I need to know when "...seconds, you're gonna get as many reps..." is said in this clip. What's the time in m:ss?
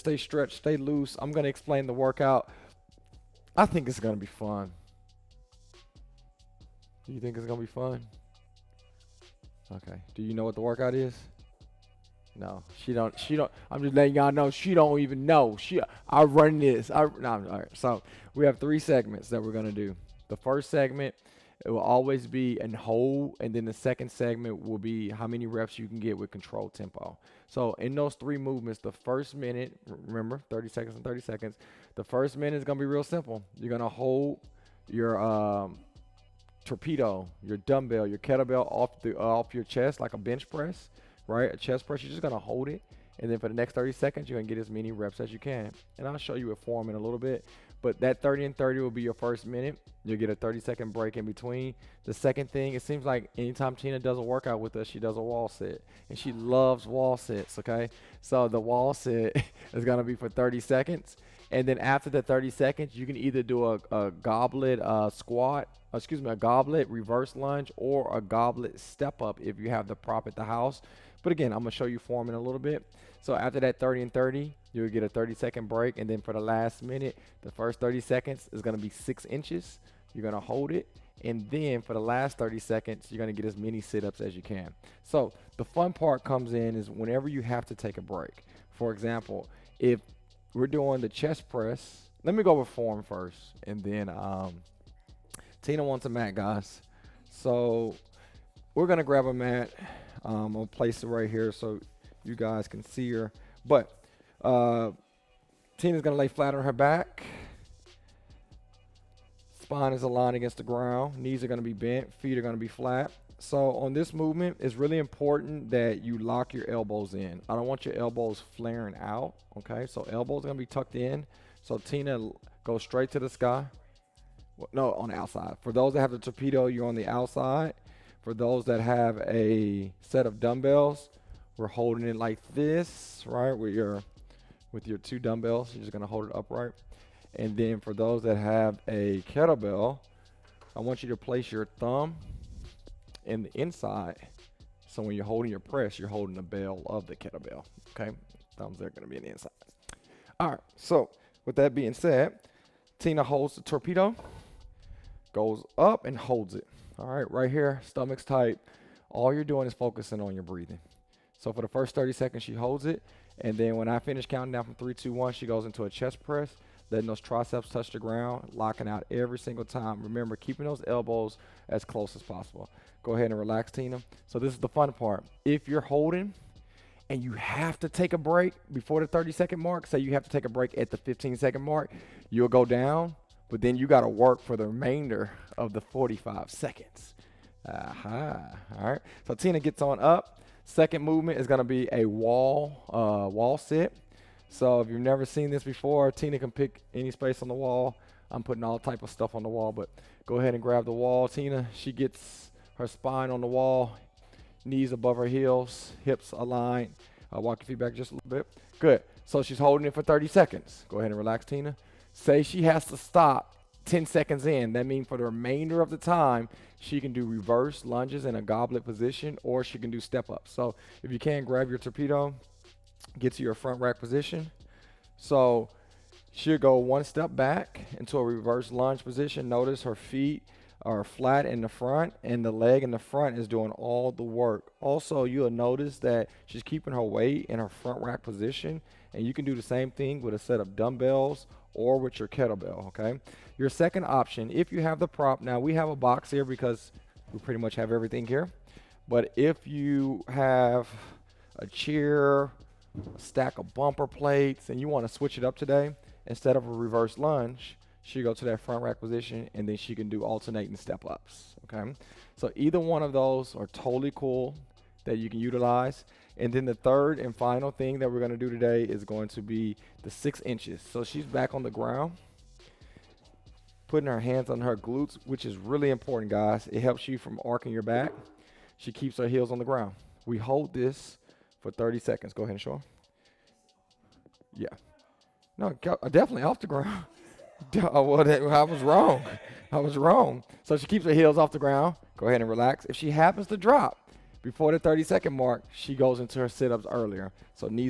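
0:43.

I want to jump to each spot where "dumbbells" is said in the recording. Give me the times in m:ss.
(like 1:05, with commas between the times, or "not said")
0:37, 2:10, 2:15, 4:00.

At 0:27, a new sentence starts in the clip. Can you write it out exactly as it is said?
So in those three movements, the first minute, remember, 30 seconds and 30 seconds.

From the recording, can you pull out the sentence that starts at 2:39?
All you're doing is focusing on your breathing.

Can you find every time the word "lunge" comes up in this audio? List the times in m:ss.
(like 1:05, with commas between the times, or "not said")
1:07, 3:37, 3:48, 4:17.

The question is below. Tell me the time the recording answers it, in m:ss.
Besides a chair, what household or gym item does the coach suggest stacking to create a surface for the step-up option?
4:13.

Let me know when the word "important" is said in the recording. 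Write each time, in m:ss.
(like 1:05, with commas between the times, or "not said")
1:54, 4:35.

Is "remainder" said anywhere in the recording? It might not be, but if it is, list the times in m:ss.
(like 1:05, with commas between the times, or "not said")
3:04, 3:35.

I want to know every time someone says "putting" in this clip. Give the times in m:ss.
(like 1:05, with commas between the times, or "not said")
3:18, 4:33.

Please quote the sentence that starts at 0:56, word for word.
And she loves wall sets, okay?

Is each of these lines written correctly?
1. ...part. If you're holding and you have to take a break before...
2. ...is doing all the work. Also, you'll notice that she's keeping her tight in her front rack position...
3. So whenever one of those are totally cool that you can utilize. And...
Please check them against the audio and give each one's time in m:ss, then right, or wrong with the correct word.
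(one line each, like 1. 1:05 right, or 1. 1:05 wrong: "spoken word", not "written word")
1. 2:54 right
2. 3:53 wrong: "weight", not "tight"
3. 4:22 wrong: "either", not "whenever".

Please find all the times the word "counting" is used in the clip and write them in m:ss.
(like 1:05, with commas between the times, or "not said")
2:44.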